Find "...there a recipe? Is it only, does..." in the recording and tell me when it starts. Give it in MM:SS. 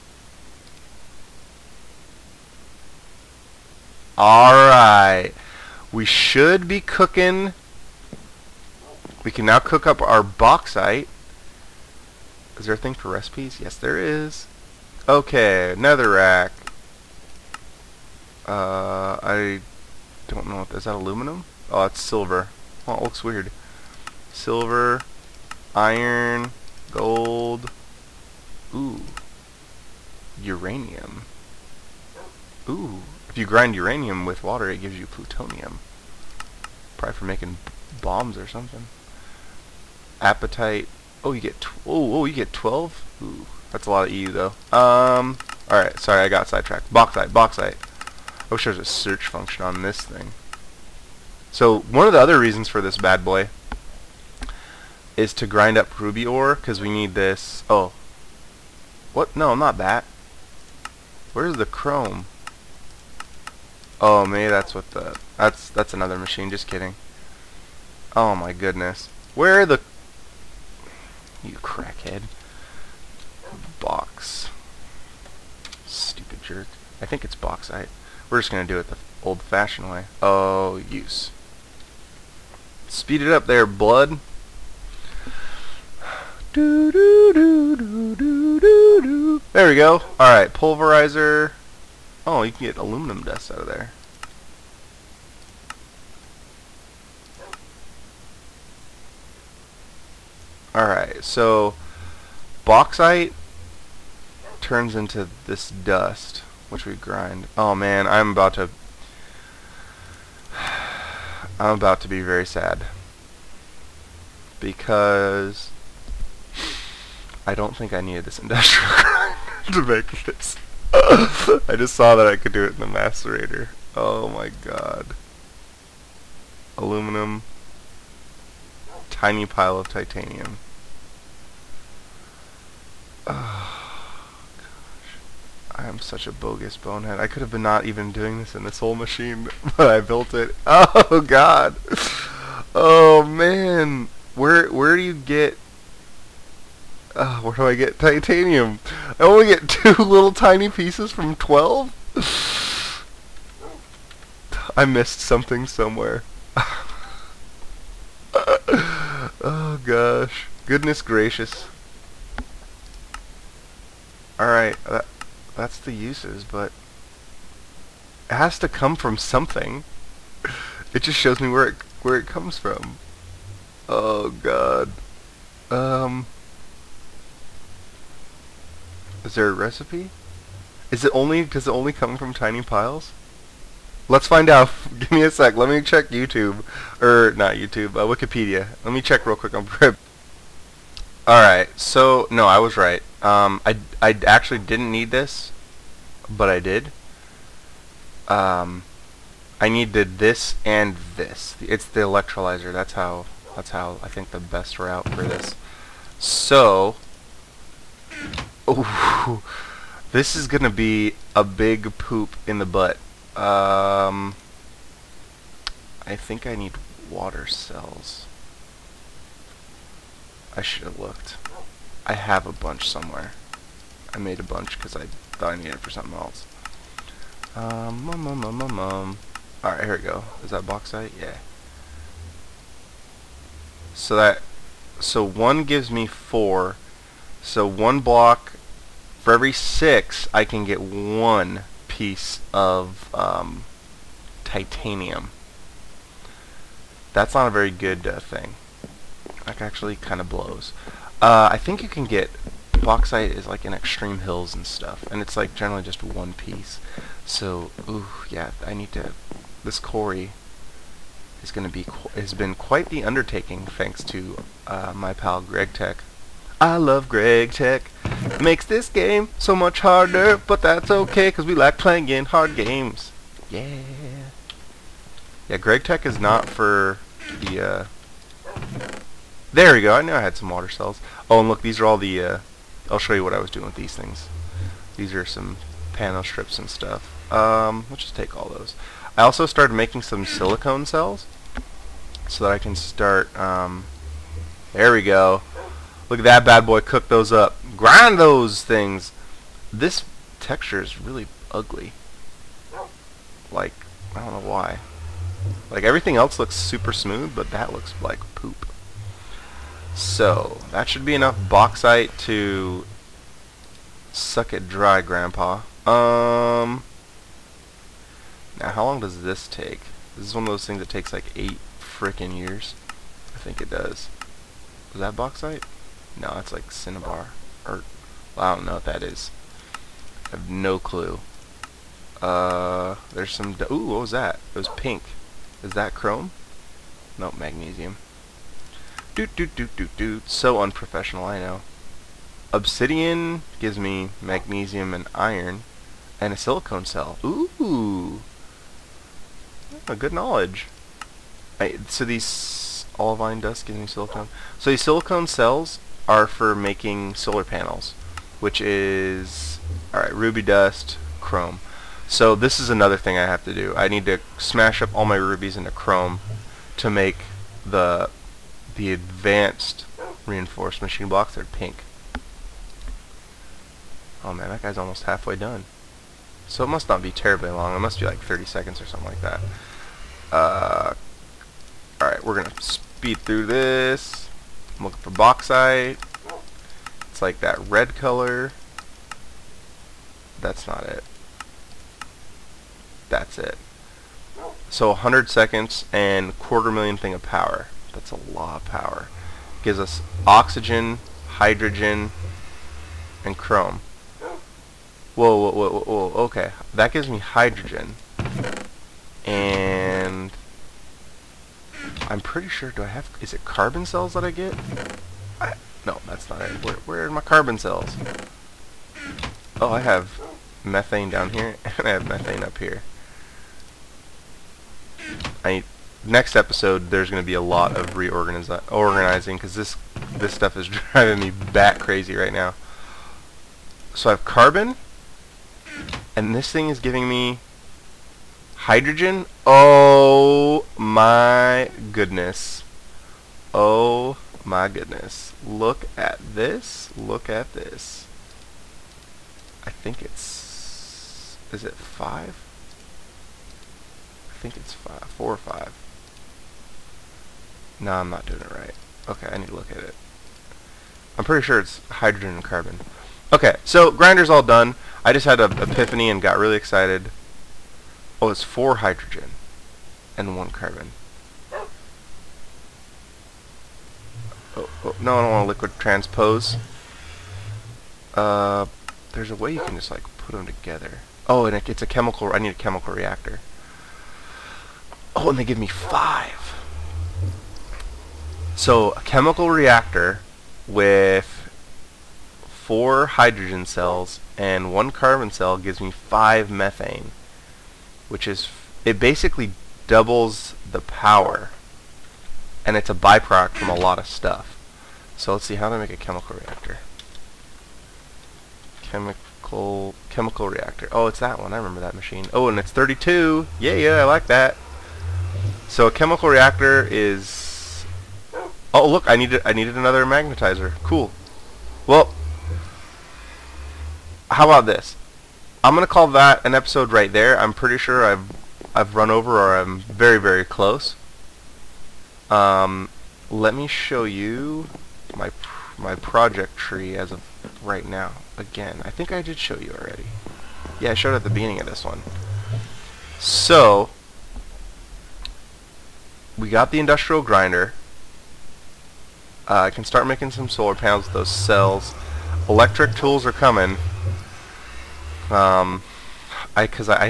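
02:59.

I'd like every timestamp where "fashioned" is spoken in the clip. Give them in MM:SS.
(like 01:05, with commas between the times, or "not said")
01:19.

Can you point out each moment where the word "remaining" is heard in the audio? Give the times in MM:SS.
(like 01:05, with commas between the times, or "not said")
not said.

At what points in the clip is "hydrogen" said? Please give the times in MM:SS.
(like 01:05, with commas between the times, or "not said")
06:41, 06:47, 07:18, 07:41, 07:48, 08:13.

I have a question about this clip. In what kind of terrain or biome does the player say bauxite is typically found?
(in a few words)
extreme hills.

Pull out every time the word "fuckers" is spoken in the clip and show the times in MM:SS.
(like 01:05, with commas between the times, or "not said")
not said.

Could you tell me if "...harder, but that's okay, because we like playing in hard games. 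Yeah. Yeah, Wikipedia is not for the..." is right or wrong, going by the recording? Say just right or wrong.
wrong.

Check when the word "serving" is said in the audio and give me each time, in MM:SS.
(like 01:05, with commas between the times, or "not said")
not said.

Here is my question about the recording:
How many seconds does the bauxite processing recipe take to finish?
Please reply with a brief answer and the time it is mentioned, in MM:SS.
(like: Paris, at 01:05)
100, at 06:34.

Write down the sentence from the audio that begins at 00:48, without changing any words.
I wish there was a search function on this thing.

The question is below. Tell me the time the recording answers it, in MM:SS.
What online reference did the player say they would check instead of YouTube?
03:08.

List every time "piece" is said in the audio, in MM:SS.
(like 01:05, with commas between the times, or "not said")
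02:30, 04:01, 04:16.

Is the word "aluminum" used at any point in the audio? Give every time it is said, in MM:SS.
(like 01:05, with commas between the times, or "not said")
00:20, 01:32, 02:06.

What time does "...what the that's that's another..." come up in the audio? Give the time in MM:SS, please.
01:04.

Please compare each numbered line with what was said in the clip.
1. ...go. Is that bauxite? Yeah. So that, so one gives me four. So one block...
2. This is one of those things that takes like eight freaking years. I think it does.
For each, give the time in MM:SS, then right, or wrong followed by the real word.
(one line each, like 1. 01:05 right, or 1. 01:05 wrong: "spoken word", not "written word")
1. 03:50 right
2. 05:20 right.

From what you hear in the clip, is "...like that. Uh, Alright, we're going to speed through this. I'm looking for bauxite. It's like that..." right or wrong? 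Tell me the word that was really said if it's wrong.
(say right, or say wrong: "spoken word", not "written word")
right.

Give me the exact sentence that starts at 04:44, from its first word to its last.
These are some panel strips and stuff.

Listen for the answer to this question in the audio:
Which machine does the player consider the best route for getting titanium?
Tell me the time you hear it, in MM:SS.
03:22.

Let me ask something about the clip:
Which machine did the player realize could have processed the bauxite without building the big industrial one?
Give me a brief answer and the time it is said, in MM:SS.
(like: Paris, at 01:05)
macerator, at 02:02.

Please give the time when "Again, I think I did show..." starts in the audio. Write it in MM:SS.
08:58.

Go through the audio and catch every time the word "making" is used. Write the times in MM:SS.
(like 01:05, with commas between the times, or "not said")
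00:37, 04:49, 05:56, 09:10.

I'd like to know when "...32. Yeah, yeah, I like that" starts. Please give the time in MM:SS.
08:32.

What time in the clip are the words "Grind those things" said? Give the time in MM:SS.
04:57.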